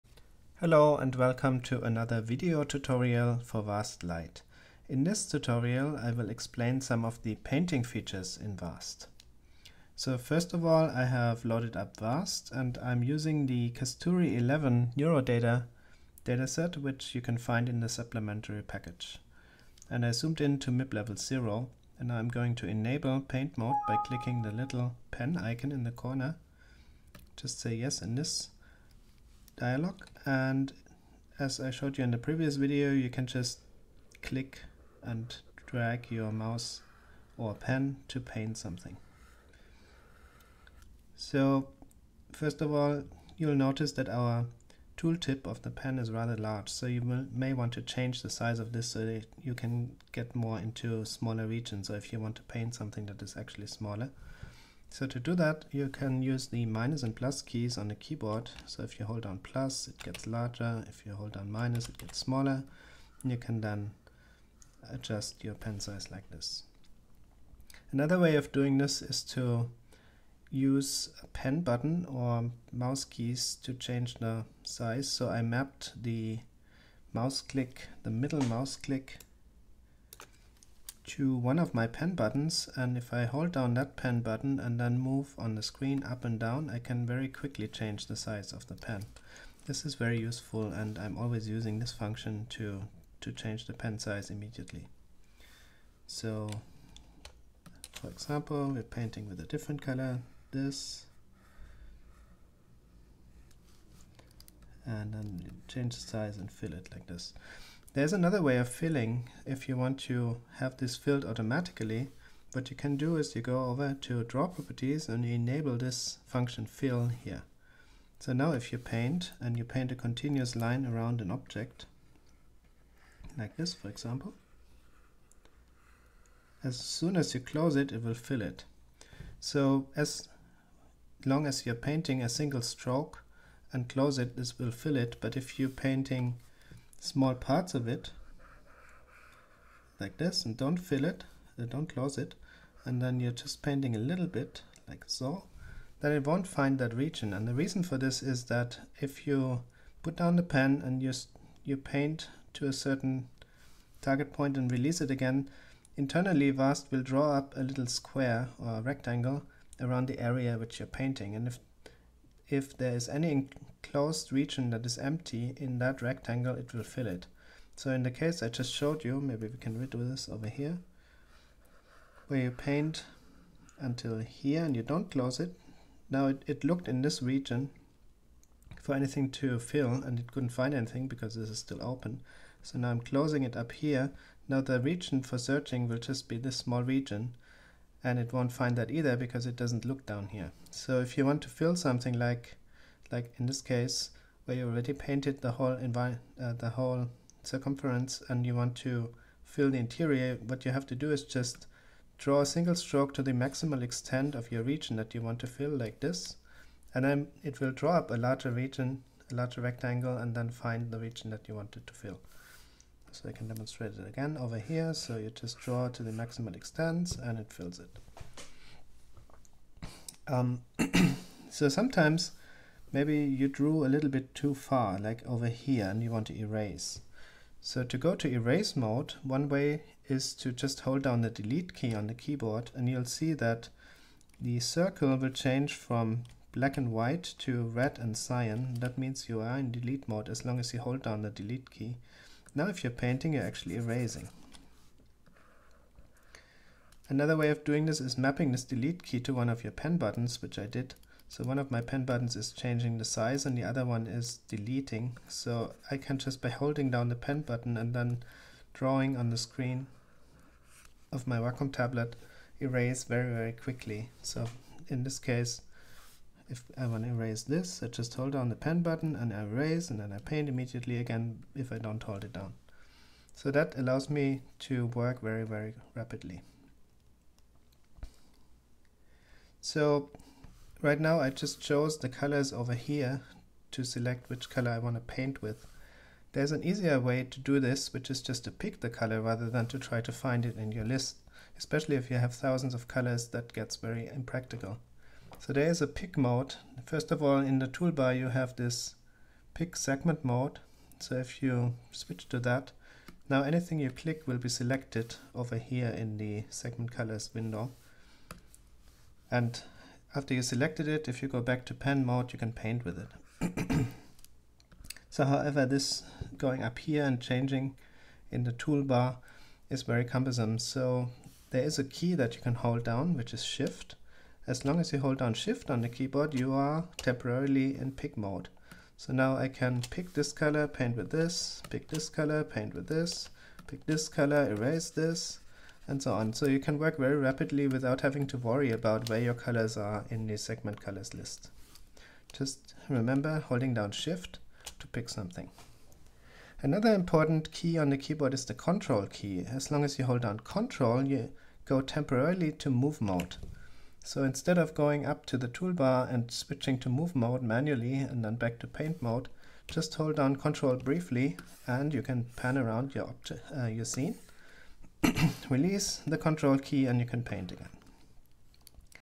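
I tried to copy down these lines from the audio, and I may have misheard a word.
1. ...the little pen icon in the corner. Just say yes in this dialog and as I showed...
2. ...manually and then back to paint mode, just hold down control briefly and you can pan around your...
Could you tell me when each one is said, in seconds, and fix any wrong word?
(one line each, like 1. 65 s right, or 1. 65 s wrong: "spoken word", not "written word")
1. 24 s right
2. 357 s right.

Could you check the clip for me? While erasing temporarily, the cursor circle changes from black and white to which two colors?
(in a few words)
red and cyan.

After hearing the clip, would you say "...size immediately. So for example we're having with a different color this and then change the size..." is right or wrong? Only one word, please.
wrong.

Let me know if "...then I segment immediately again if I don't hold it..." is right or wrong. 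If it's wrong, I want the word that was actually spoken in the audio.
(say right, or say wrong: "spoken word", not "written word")
wrong: "paint", not "segment".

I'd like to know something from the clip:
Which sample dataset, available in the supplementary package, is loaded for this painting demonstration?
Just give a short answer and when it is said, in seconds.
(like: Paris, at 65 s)
Kasthuri 11, at 13 s.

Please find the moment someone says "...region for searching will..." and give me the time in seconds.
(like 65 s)
184 s.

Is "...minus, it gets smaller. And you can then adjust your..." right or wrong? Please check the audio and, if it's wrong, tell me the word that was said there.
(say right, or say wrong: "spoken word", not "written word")
right.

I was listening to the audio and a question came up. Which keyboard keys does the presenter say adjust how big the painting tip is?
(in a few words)
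minus and plus.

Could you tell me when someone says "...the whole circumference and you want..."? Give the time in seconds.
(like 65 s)
196 s.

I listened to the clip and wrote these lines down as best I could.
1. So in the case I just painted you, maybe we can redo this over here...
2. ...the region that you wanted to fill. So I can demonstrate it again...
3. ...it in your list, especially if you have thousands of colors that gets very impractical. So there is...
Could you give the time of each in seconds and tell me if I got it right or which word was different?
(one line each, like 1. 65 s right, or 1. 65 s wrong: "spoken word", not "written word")
1. 167 s wrong: "showed", not "painted"
2. 210 s right
3. 290 s right.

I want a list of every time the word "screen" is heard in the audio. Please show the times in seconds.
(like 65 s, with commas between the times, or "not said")
85 s, 259 s.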